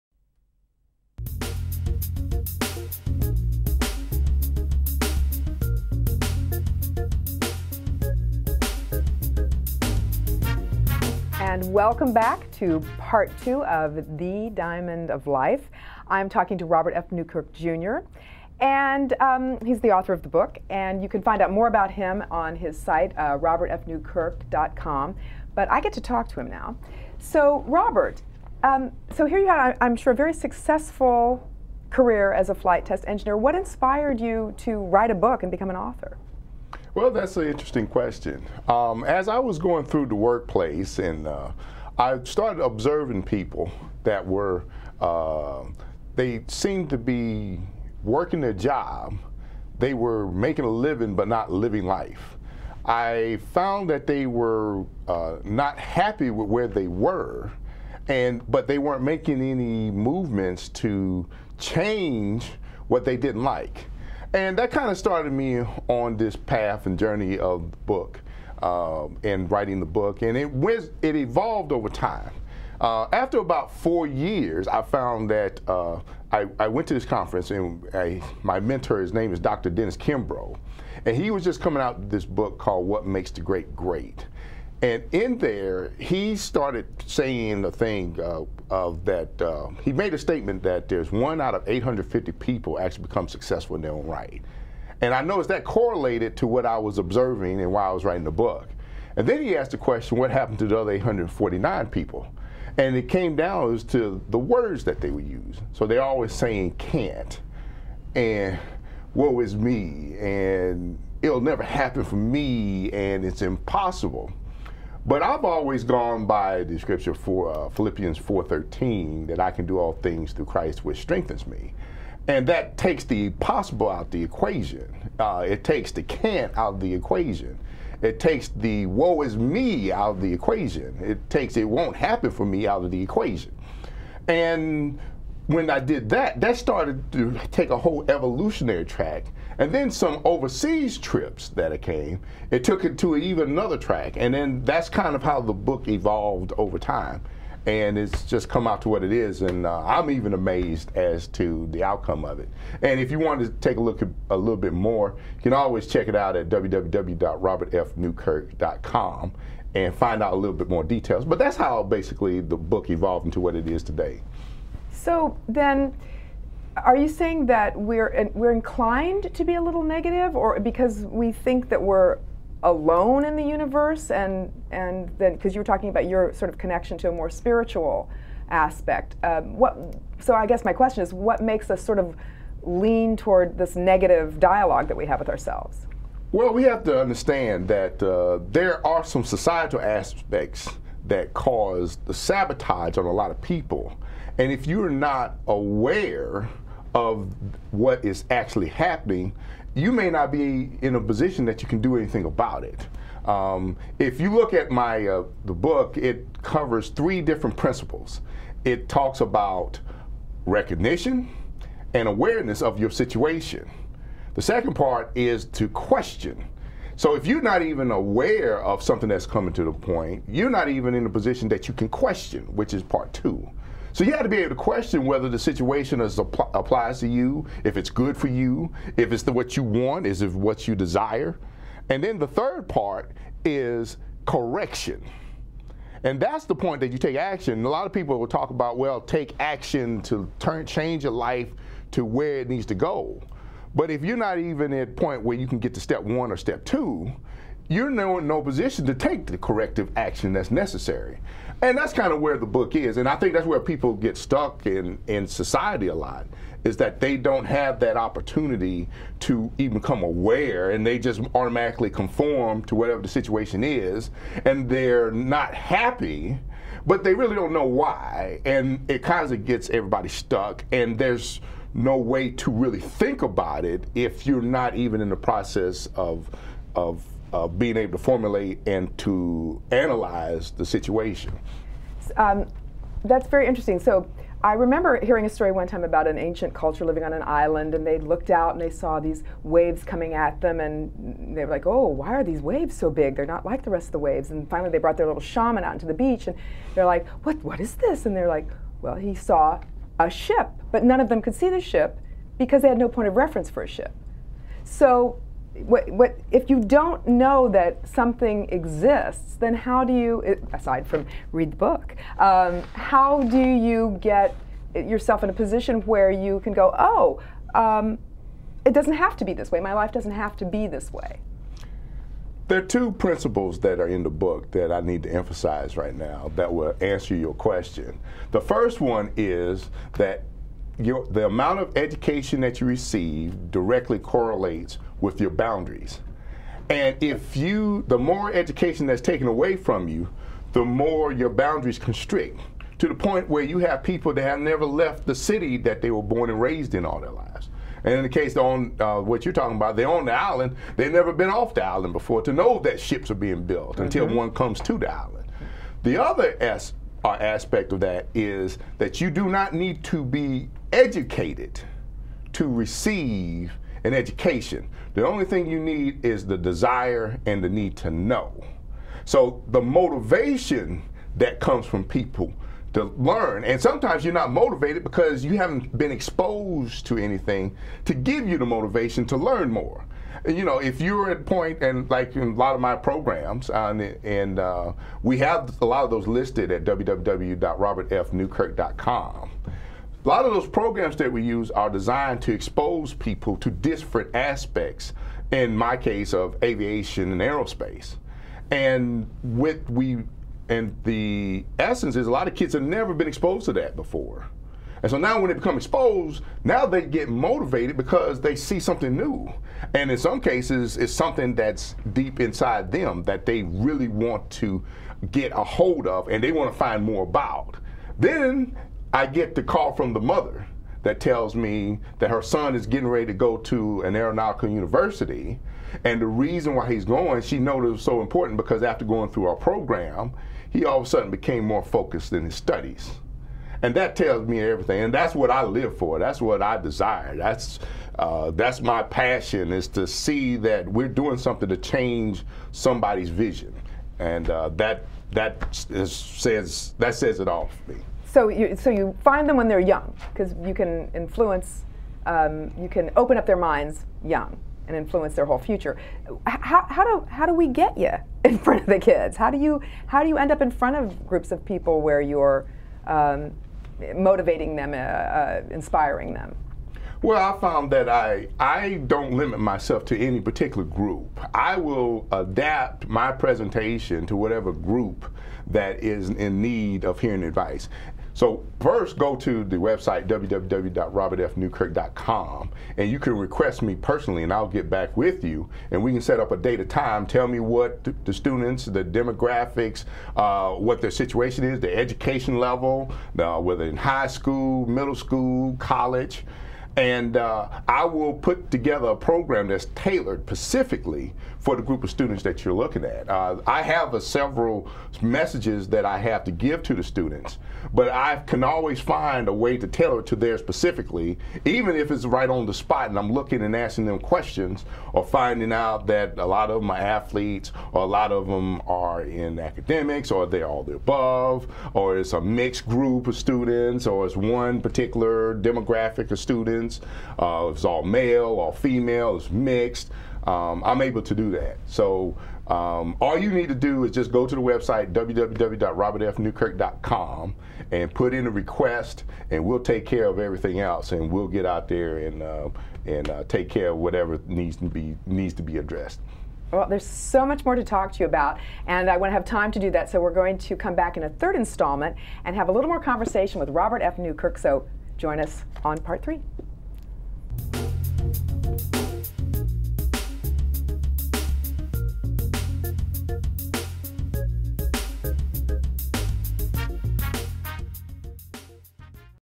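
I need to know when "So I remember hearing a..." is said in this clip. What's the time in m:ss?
4:43.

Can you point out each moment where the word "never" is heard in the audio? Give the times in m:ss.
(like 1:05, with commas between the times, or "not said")
1:51, 5:44, 5:50, 6:42.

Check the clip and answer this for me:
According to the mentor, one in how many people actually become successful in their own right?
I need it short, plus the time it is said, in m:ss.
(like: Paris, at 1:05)
850, at 1:31.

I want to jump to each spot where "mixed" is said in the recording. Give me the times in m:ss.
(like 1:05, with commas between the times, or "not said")
8:42, 8:49.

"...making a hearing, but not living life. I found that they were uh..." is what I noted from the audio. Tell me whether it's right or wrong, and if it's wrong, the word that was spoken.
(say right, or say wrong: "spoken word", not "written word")
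wrong: "living", not "hearing".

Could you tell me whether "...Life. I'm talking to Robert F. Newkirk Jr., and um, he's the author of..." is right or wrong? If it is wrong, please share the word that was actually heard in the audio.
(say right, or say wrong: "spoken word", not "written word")
right.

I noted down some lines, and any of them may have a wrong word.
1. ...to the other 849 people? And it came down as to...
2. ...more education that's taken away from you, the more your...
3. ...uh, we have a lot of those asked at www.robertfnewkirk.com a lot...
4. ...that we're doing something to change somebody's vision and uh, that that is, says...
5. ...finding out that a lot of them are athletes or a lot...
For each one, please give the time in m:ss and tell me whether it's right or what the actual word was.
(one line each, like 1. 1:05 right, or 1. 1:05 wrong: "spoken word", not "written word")
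1. 1:40 right
2. 5:37 right
3. 6:24 wrong: "listed", not "asked"
4. 7:20 right
5. 8:35 right.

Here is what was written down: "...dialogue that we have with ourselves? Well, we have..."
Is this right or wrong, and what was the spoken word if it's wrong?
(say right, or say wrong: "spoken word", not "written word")
right.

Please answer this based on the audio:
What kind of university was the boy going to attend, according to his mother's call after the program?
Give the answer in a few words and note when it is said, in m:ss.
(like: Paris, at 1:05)
aeronautical university, at 7:03.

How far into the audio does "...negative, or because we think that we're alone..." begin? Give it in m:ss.
2:49.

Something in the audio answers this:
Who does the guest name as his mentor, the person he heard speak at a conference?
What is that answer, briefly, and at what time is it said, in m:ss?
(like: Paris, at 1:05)
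Dr. Dennis Kimbro, at 1:19.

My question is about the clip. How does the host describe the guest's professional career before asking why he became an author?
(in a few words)
flight test engineer.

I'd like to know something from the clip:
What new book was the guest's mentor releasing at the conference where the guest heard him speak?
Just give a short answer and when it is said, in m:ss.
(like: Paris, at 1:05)
What Makes the Great Great, at 1:22.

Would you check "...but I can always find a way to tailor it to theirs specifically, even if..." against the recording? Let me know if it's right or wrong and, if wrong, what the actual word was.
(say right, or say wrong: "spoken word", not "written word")
right.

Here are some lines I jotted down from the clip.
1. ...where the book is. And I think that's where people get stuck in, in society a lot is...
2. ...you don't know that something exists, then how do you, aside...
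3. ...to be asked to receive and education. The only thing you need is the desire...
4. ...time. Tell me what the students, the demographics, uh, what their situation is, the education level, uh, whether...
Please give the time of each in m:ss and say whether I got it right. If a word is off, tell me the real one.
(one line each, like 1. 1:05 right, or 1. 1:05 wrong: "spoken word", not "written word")
1. 4:12 right
2. 5:06 right
3. 5:59 wrong: "educated", not "asked"
4. 8:06 right.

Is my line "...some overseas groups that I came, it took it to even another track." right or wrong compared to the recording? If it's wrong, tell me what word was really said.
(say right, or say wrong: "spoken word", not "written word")
wrong: "trips", not "groups".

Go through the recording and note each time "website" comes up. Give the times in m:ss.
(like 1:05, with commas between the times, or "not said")
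7:59, 8:54.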